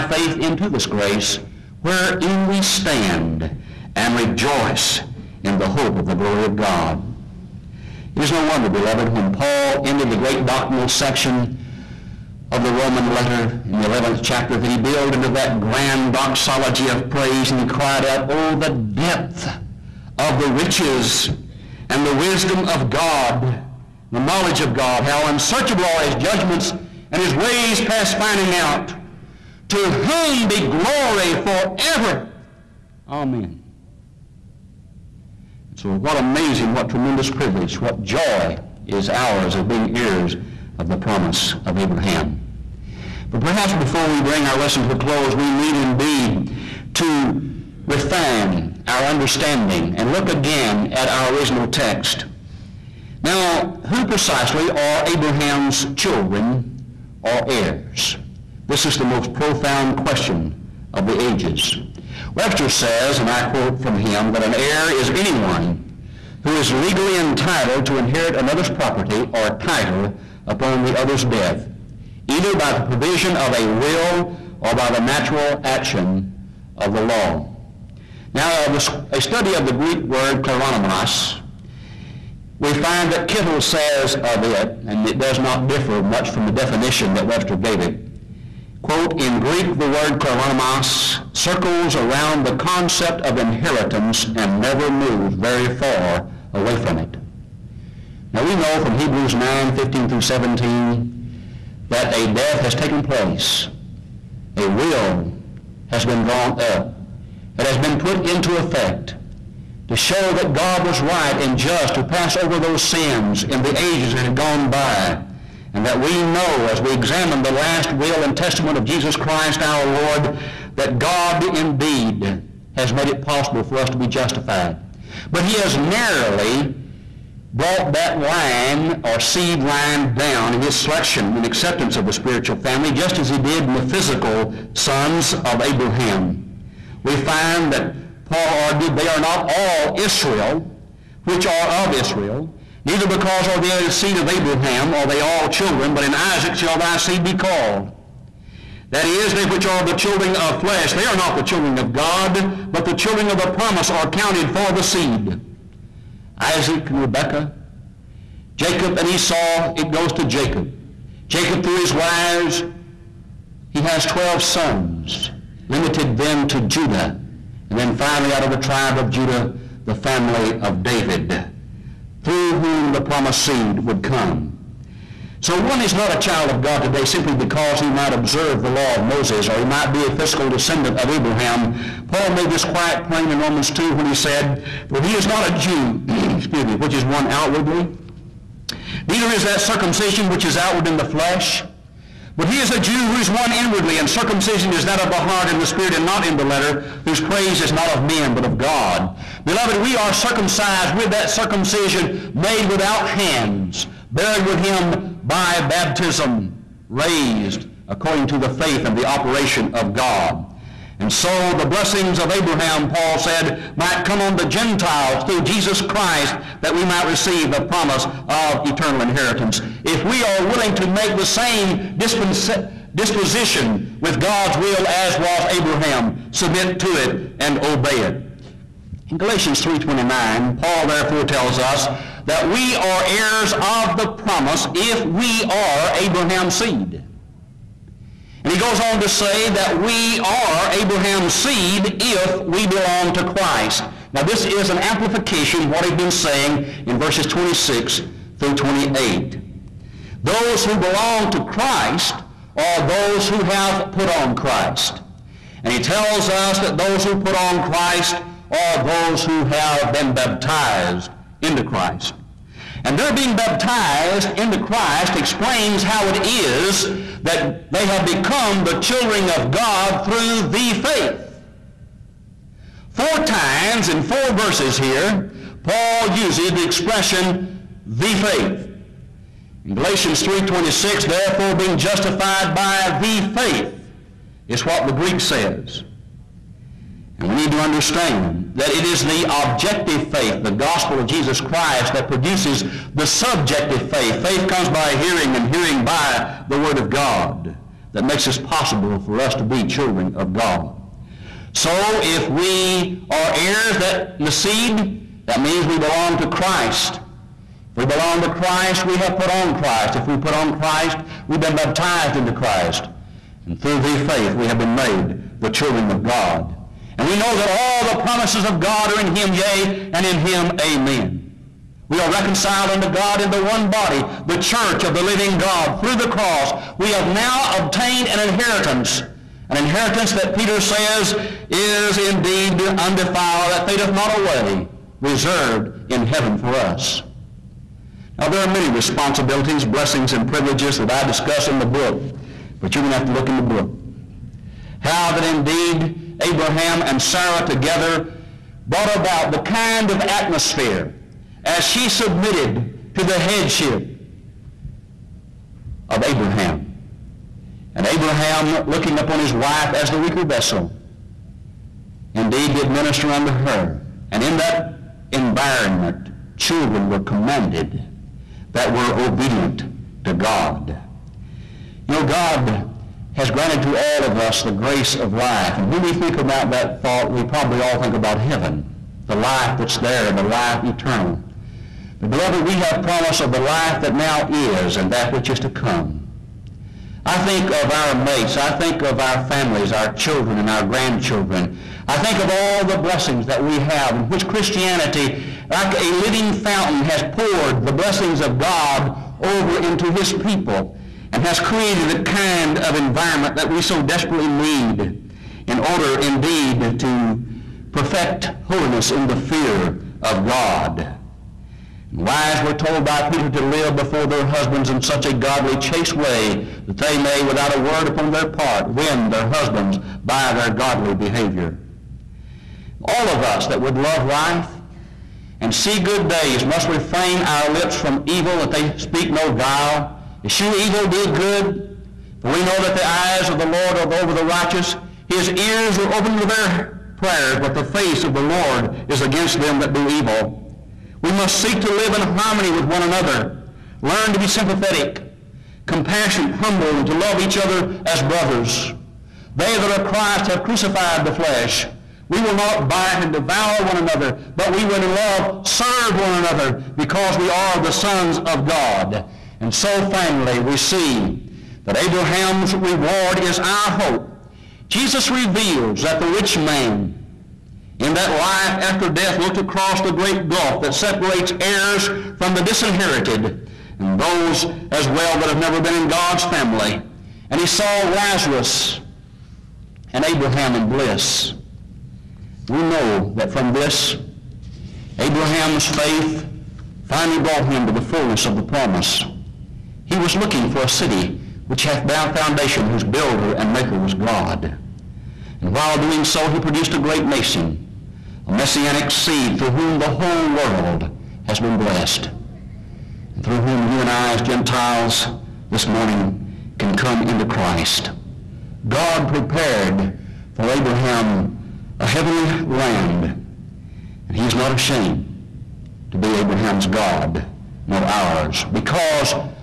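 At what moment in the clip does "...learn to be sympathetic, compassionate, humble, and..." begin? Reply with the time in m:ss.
7:23.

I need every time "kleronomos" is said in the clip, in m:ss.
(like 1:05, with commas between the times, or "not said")
1:20, 1:30.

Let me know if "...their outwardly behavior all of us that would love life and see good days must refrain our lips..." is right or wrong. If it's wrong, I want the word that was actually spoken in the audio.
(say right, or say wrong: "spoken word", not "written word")
wrong: "godly", not "outwardly".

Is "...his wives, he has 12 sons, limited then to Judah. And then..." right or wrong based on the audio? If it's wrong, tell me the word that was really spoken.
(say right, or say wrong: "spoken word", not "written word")
right.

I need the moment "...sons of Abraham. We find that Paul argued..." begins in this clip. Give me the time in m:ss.
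2:14.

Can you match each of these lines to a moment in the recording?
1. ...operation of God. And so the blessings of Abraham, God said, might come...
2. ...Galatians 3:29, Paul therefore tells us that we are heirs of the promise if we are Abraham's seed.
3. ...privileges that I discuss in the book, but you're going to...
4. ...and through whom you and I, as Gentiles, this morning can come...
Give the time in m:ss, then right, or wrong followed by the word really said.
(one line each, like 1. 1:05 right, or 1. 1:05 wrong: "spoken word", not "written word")
1. 3:29 wrong: "Paul", not "God"
2. 3:49 right
3. 5:40 right
4. 8:23 right.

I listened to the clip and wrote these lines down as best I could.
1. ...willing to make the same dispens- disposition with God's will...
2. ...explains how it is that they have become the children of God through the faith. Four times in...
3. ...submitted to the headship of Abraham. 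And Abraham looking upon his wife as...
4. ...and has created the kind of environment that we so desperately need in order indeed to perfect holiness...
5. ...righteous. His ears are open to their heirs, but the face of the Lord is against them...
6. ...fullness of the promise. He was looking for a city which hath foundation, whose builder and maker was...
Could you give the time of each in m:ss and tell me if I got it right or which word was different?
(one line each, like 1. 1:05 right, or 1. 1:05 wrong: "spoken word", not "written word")
1. 3:40 right
2. 4:25 right
3. 5:51 right
4. 6:41 right
5. 7:14 wrong: "prayers", not "heirs"
6. 8:07 right.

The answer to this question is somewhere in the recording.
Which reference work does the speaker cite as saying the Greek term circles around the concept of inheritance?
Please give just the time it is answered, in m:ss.
1:23.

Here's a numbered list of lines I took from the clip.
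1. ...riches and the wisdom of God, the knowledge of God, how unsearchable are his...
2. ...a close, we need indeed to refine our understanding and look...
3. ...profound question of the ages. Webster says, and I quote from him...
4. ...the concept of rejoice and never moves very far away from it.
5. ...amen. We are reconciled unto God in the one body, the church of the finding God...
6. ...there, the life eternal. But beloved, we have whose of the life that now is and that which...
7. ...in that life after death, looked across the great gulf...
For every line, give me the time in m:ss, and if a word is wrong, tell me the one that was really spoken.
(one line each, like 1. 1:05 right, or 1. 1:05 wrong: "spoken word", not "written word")
1. 0:20 right
2. 0:44 right
3. 0:59 right
4. 1:32 wrong: "inheritance", not "rejoice"
5. 5:20 wrong: "living", not "finding"
6. 6:19 wrong: "promise", not "whose"
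7. 7:47 right.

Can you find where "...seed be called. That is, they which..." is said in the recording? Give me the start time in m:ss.
2:26.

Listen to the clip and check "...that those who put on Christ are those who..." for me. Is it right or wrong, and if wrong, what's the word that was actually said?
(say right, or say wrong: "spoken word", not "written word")
right.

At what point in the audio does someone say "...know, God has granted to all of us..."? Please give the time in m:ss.
6:11.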